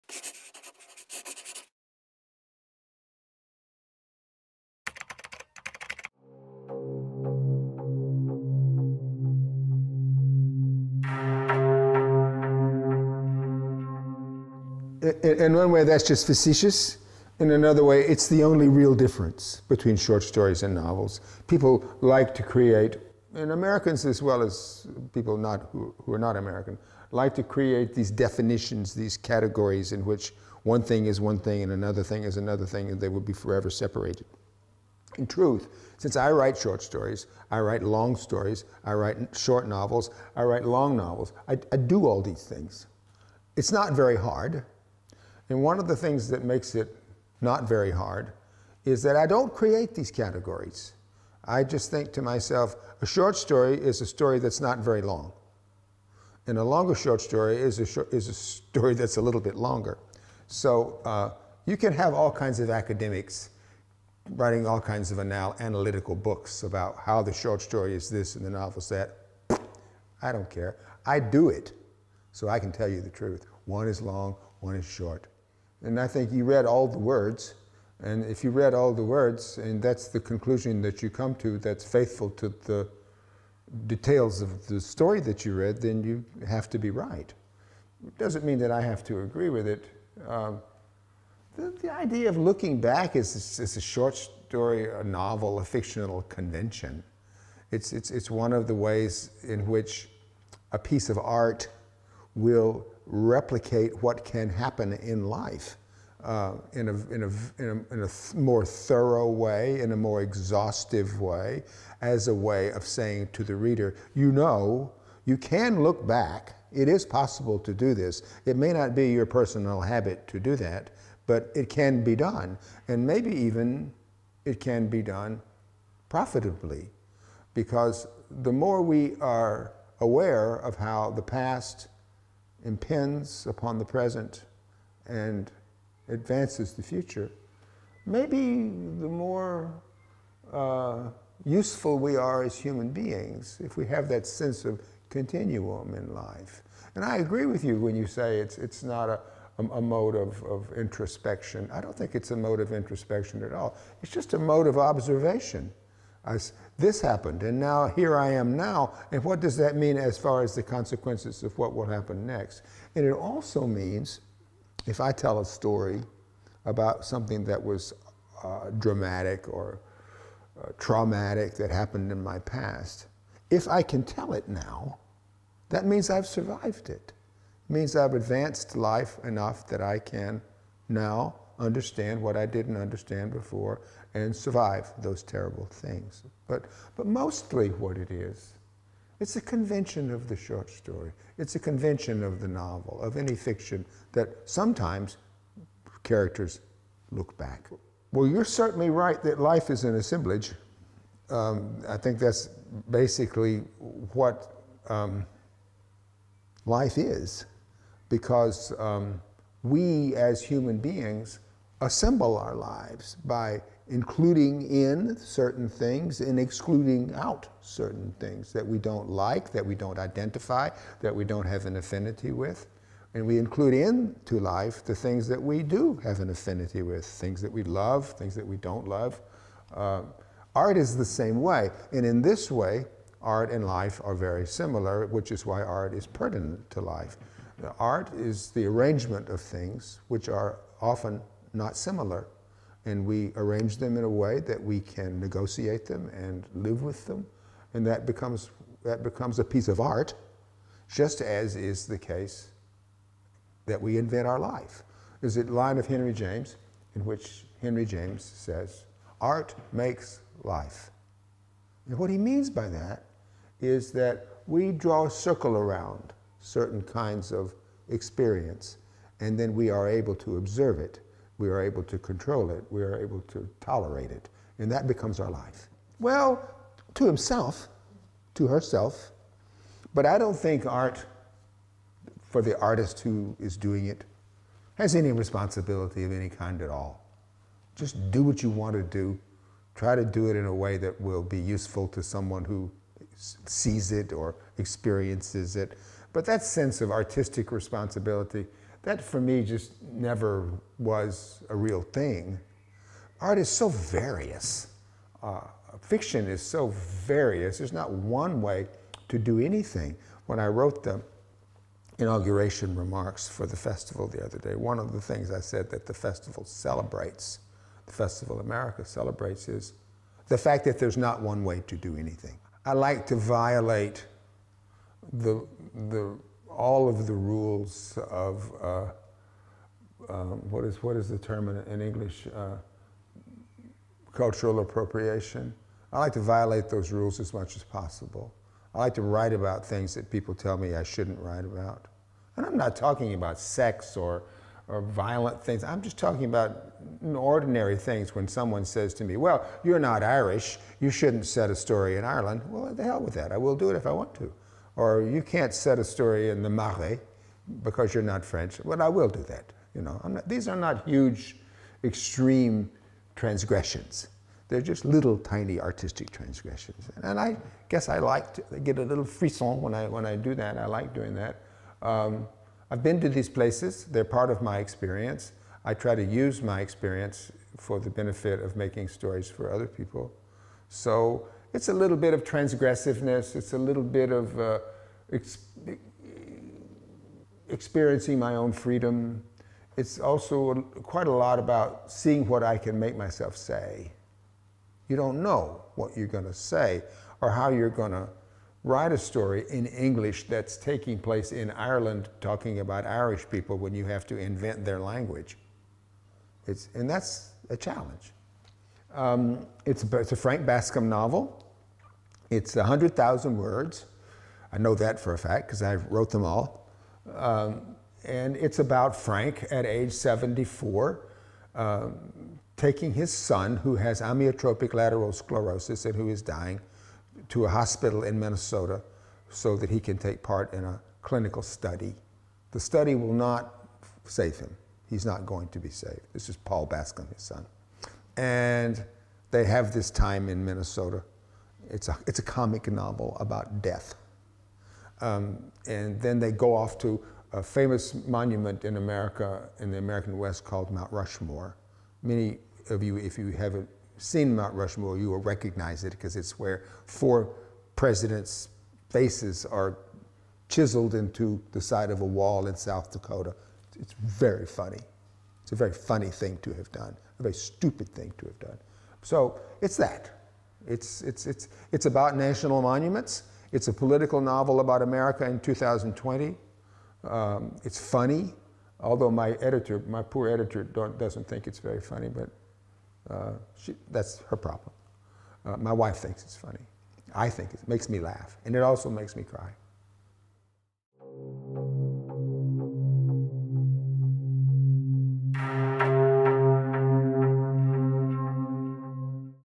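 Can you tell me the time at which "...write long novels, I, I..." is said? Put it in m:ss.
0:40.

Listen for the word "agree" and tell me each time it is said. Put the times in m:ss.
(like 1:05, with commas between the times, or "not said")
1:29, 2:27.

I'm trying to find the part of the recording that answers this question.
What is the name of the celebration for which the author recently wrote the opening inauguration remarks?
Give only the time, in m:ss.
5:17.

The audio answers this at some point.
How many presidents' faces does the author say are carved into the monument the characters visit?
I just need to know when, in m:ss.
7:36.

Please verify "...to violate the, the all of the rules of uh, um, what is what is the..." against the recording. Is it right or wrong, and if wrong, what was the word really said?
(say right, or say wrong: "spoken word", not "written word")
right.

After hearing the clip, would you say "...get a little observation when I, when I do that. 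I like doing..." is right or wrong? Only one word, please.
wrong.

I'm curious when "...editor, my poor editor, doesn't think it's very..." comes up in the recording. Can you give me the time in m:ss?
7:59.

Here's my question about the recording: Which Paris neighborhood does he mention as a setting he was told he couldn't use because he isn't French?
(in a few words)
the Marais.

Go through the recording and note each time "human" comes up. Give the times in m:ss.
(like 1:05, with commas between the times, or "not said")
2:22, 3:30.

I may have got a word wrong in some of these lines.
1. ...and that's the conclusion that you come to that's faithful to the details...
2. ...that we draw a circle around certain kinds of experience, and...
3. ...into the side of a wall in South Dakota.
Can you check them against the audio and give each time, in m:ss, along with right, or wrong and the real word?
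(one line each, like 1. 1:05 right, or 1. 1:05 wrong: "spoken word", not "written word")
1. 1:19 right
2. 4:23 right
3. 7:40 right.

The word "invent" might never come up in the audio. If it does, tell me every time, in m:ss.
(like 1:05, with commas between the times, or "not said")
4:13, 6:44.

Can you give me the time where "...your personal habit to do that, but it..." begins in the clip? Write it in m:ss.
1:59.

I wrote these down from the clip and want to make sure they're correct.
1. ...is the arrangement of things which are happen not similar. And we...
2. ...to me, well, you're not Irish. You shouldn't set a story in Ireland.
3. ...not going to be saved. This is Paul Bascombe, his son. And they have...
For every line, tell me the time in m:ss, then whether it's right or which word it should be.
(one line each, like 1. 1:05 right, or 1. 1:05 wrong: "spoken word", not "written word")
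1. 3:58 wrong: "often", not "happen"
2. 5:48 right
3. 7:15 right.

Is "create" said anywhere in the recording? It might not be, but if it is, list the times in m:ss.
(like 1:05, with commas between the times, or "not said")
0:22, 0:27, 0:49.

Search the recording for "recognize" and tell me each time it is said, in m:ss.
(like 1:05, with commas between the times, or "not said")
7:35.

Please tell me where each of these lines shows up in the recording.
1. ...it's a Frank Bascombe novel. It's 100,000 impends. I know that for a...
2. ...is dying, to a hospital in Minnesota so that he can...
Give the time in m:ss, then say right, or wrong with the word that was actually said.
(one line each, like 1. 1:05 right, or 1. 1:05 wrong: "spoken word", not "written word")
1. 6:49 wrong: "words", not "impends"
2. 7:06 right.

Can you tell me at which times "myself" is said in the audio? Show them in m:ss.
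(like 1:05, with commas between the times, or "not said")
0:52, 6:32.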